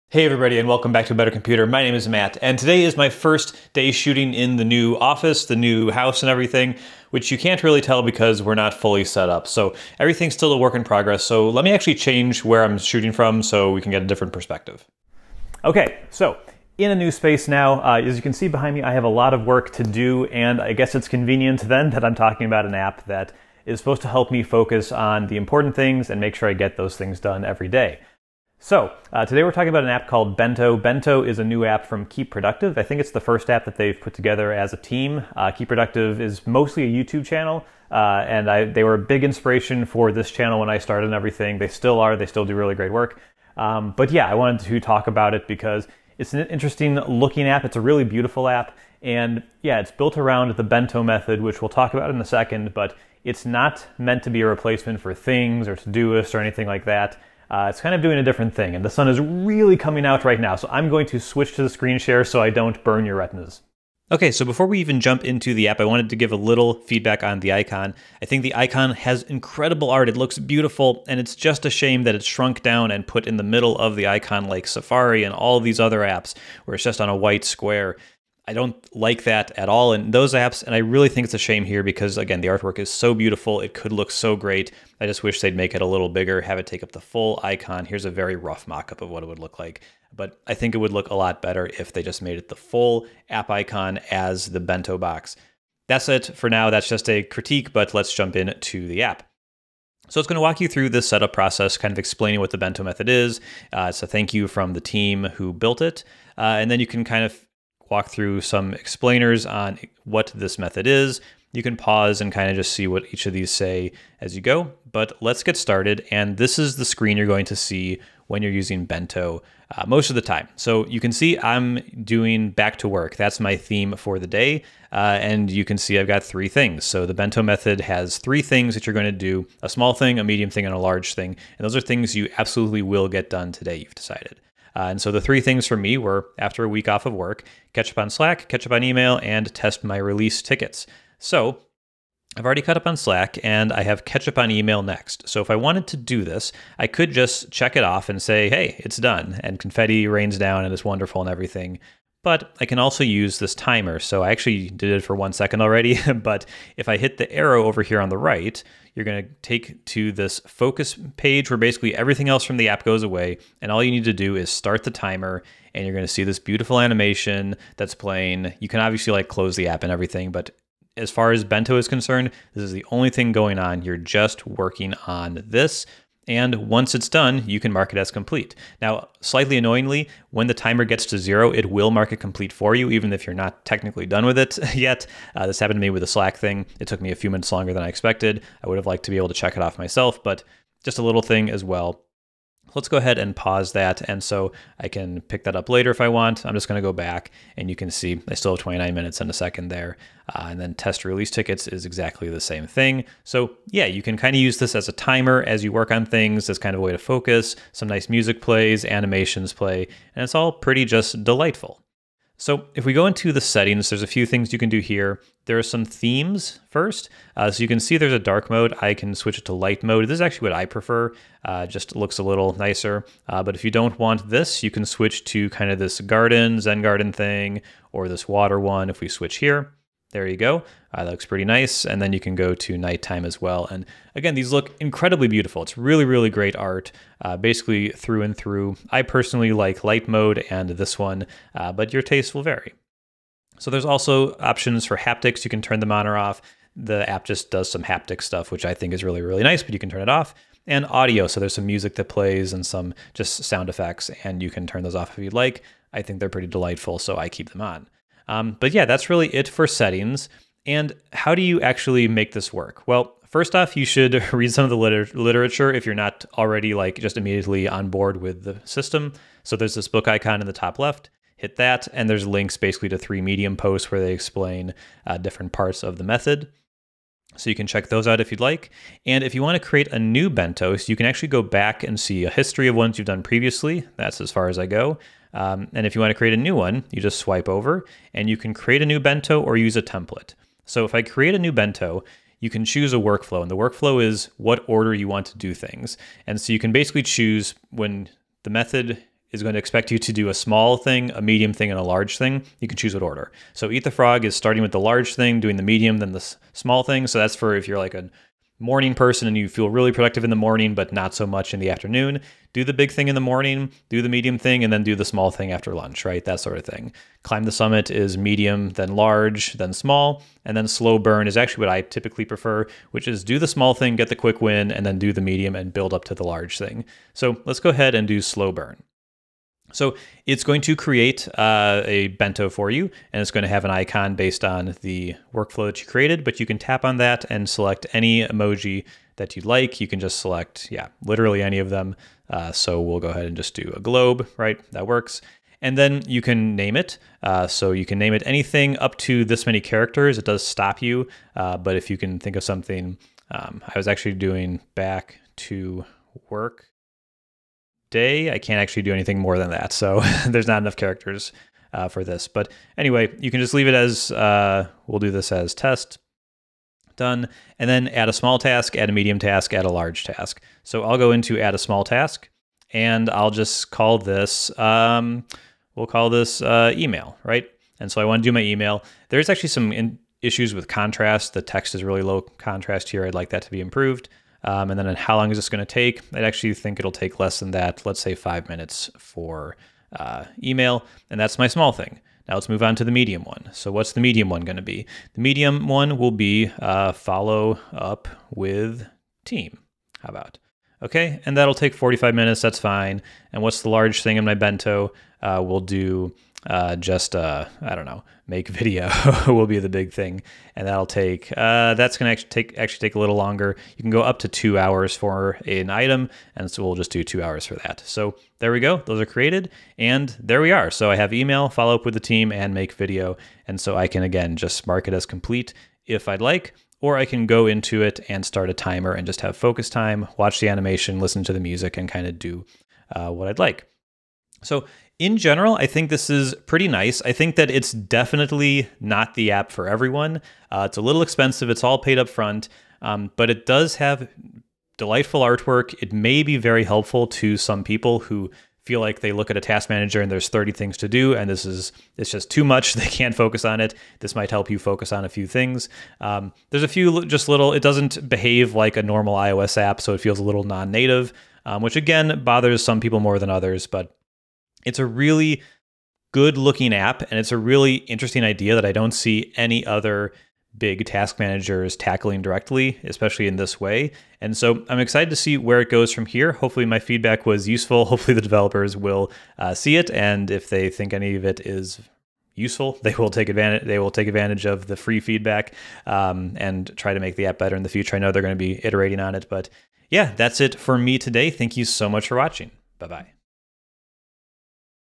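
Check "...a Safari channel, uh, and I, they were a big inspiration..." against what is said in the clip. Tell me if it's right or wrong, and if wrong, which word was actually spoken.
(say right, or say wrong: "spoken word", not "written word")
wrong: "YouTube", not "Safari".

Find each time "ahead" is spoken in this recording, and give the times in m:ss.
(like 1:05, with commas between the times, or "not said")
3:12, 5:27, 5:43.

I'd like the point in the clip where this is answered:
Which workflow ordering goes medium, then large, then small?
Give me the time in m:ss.
5:17.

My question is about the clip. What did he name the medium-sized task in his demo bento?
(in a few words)
follow up with team.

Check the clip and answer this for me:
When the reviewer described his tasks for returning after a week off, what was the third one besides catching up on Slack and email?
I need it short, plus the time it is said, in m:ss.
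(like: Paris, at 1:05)
test my release tickets, at 2:19.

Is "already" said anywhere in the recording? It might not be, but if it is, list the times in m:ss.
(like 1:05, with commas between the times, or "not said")
2:22, 2:35, 4:26.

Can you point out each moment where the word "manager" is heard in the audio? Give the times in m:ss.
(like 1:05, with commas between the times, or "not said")
7:29, 7:51.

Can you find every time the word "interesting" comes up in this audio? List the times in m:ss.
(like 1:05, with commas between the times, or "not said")
0:46, 7:47.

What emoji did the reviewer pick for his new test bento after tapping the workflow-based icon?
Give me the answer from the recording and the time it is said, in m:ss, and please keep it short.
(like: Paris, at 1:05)
a globe, at 5:43.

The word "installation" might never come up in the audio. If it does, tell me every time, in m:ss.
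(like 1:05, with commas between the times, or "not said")
not said.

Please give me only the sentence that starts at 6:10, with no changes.
So I'll go into add a small task and I'll just call this, um, we'll call this uh, email, right?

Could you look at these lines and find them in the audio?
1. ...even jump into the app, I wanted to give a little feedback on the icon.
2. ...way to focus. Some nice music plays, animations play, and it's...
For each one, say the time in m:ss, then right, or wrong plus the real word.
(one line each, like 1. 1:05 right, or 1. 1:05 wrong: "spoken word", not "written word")
1. 1:04 right
2. 3:26 right.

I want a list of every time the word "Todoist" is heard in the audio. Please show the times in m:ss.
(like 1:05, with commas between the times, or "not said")
0:55.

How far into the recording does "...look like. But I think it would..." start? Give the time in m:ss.
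1:29.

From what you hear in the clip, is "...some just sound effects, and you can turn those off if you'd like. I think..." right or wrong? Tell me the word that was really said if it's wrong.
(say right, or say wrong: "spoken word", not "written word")
right.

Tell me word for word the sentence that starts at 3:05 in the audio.
Uh, this happened to me with the Slack thing.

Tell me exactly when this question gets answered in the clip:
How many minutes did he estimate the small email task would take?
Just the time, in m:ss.
6:28.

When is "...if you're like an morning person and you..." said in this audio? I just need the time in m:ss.
5:07.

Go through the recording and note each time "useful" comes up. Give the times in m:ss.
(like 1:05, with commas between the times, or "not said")
7:57, 8:02.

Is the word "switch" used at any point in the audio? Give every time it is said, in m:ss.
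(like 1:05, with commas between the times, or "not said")
1:01, 3:39, 3:44, 3:49.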